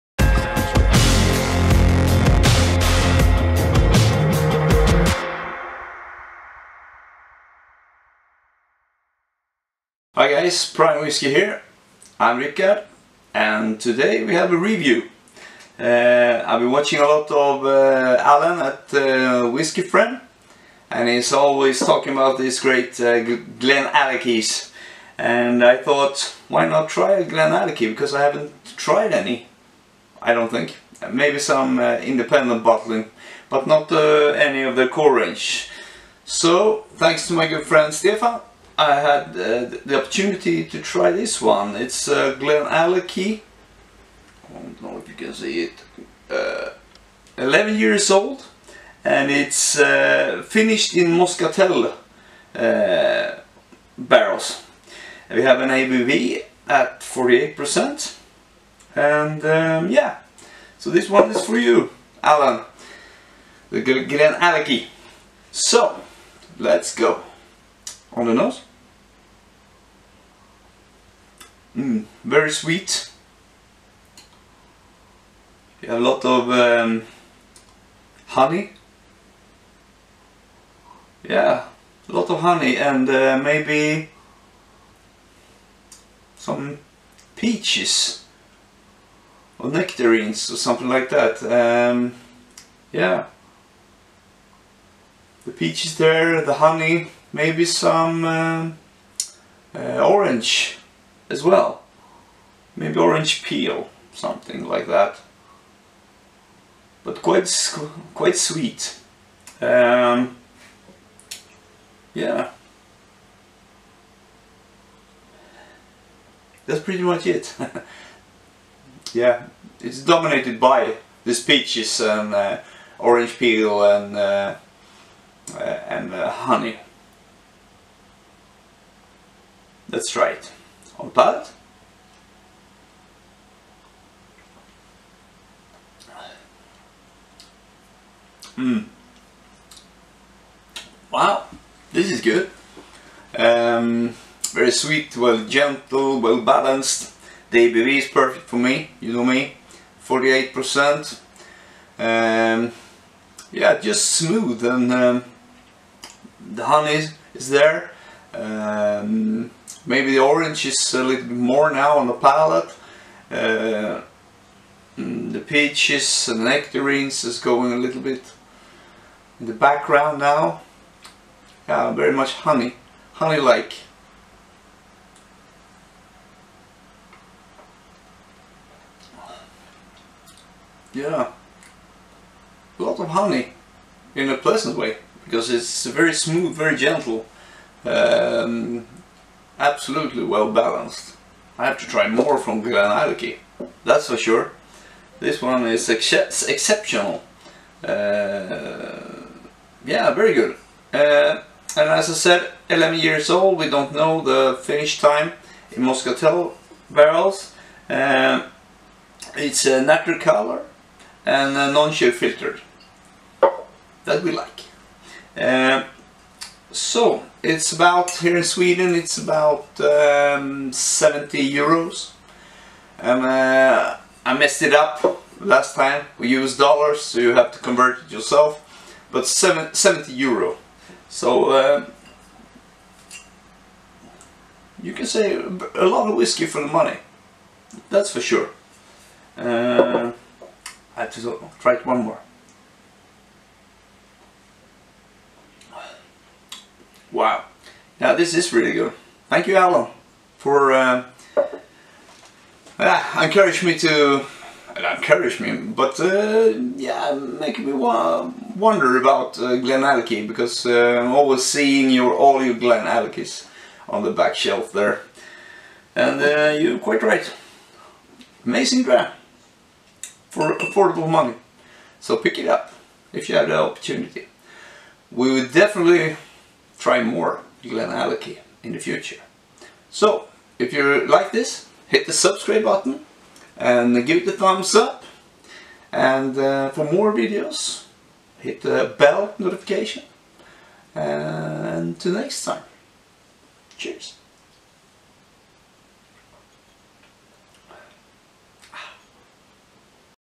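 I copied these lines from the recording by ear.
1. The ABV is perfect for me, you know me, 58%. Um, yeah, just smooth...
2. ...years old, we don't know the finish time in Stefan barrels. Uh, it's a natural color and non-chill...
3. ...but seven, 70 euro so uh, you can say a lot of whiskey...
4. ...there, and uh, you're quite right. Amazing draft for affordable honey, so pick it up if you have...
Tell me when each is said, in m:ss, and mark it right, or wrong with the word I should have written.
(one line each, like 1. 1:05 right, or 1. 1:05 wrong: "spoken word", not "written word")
1. 2:27 wrong: "48", not "58"
2. 3:22 wrong: "Moscatel", not "Stefan"
3. 3:49 right
4. 4:24 wrong: "money", not "honey".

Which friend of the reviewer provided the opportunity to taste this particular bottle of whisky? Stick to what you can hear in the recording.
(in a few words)
Stefan.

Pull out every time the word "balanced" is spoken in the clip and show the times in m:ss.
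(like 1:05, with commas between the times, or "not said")
2:26, 3:10.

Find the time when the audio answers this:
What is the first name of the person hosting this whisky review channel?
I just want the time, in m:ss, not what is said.
0:12.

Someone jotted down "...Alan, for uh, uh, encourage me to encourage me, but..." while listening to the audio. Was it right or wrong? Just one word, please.
right.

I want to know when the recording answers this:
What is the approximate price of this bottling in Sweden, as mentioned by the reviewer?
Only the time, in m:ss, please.
3:40.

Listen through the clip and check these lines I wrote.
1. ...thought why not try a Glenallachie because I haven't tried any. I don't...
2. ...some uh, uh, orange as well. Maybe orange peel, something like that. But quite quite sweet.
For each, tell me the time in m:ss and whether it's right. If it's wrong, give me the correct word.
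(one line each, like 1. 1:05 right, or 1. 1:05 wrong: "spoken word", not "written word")
1. 0:25 right
2. 1:37 right.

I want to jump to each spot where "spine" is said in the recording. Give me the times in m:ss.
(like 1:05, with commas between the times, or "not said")
not said.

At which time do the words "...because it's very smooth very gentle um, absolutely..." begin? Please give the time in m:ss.
3:05.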